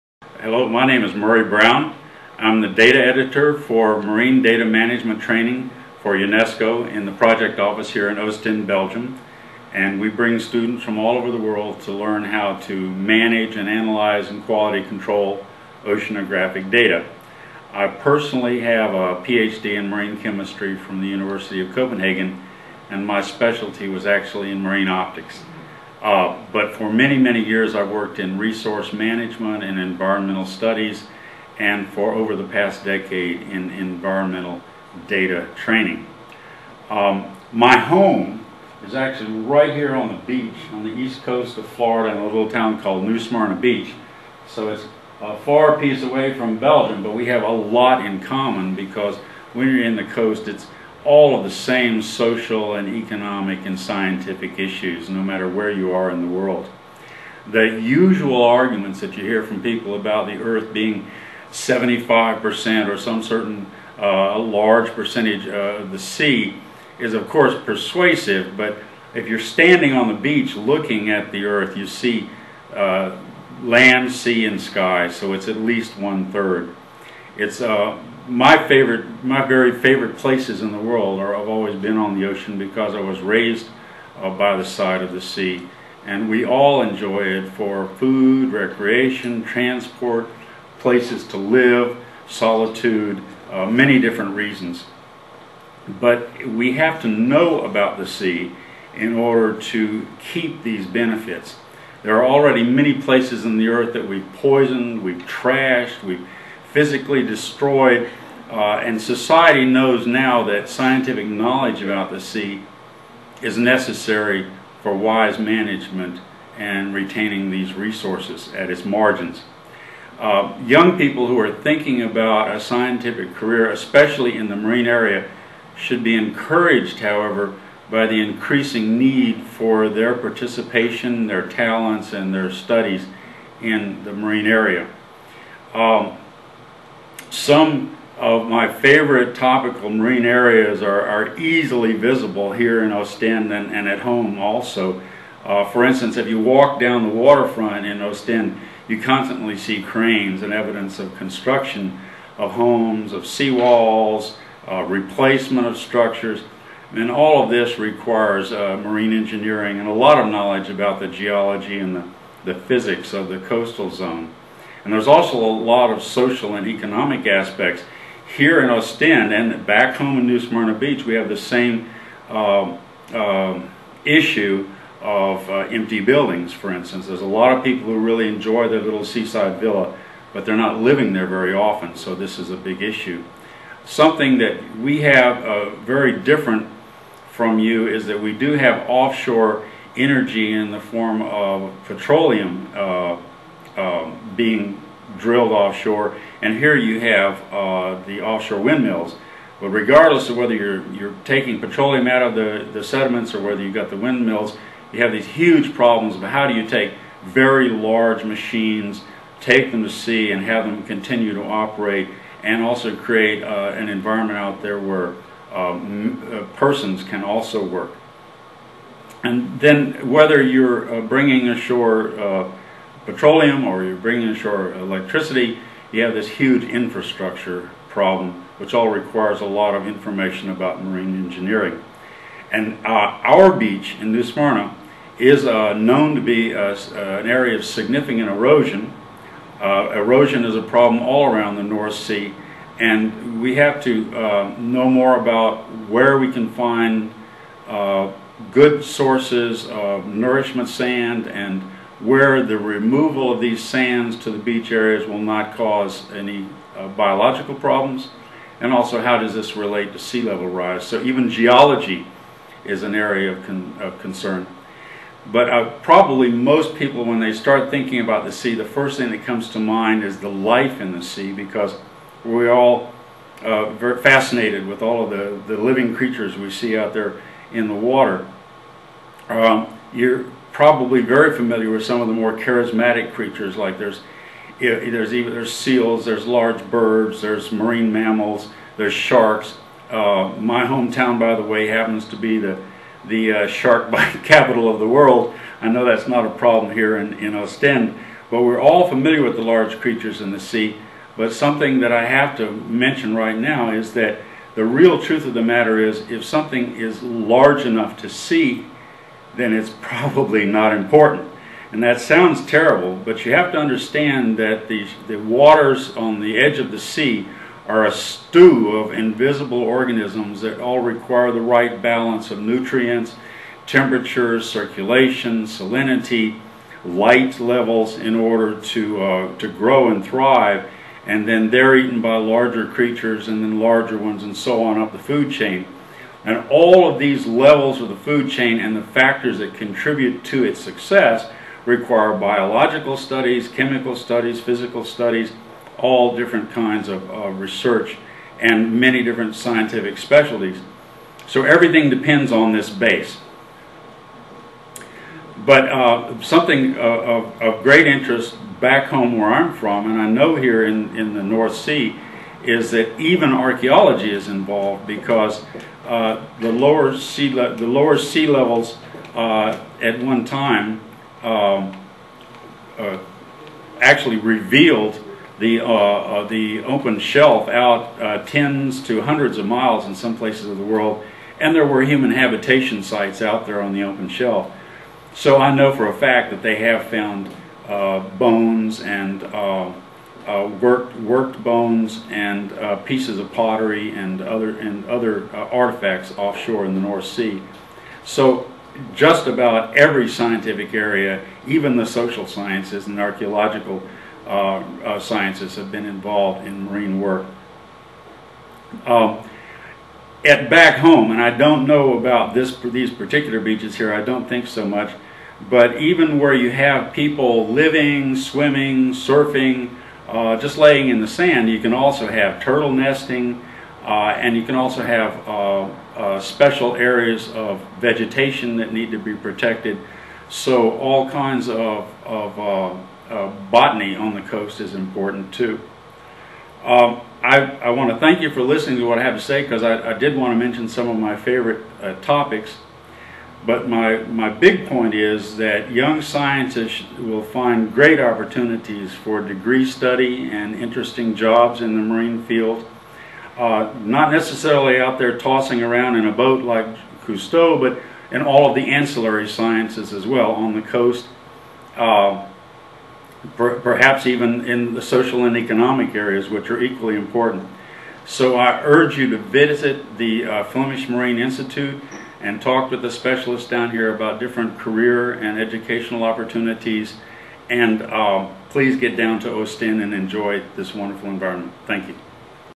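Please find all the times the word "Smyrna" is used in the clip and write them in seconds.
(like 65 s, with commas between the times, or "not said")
43 s, 170 s, 234 s.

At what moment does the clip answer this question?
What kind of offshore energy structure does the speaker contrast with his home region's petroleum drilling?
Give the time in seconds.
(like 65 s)
198 s.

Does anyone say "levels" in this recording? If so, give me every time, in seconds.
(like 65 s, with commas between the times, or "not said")
260 s, 327 s, 337 s, 368 s.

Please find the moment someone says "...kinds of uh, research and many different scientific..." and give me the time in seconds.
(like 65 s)
346 s.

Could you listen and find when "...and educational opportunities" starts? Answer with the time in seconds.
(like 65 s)
475 s.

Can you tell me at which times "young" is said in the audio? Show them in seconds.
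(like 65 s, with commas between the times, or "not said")
120 s, 445 s.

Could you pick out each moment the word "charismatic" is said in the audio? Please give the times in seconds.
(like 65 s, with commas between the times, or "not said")
282 s.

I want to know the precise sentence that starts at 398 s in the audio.
So just about every scientific area, even the social sciences and archaeological uh, uh, sciences, have been involved in marine work.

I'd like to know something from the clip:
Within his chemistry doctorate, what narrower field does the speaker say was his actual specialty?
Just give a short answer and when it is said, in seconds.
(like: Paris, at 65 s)
Marine optics, at 24 s.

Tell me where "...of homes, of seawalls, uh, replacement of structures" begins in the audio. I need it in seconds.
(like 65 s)
152 s.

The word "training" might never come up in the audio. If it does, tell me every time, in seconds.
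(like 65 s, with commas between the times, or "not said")
5 s, 35 s.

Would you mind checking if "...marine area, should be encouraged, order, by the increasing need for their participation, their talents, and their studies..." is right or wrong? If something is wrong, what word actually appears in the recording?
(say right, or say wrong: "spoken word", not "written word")
wrong: "however", not "order".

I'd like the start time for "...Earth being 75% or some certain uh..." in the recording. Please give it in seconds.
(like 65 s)
60 s.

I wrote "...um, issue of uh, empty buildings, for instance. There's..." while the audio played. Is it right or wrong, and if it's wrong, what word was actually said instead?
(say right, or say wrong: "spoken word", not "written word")
right.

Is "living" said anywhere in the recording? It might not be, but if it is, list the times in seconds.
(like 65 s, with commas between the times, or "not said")
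180 s, 275 s, 417 s.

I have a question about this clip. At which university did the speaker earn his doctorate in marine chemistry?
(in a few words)
University of Copenhagen.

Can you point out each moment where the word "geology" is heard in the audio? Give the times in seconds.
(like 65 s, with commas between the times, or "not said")
161 s, 261 s.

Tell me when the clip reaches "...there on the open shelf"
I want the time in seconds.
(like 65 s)
383 s.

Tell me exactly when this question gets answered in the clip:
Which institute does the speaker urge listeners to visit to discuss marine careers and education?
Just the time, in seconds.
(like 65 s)
470 s.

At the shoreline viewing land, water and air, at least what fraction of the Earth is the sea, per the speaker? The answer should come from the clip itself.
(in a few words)
One third.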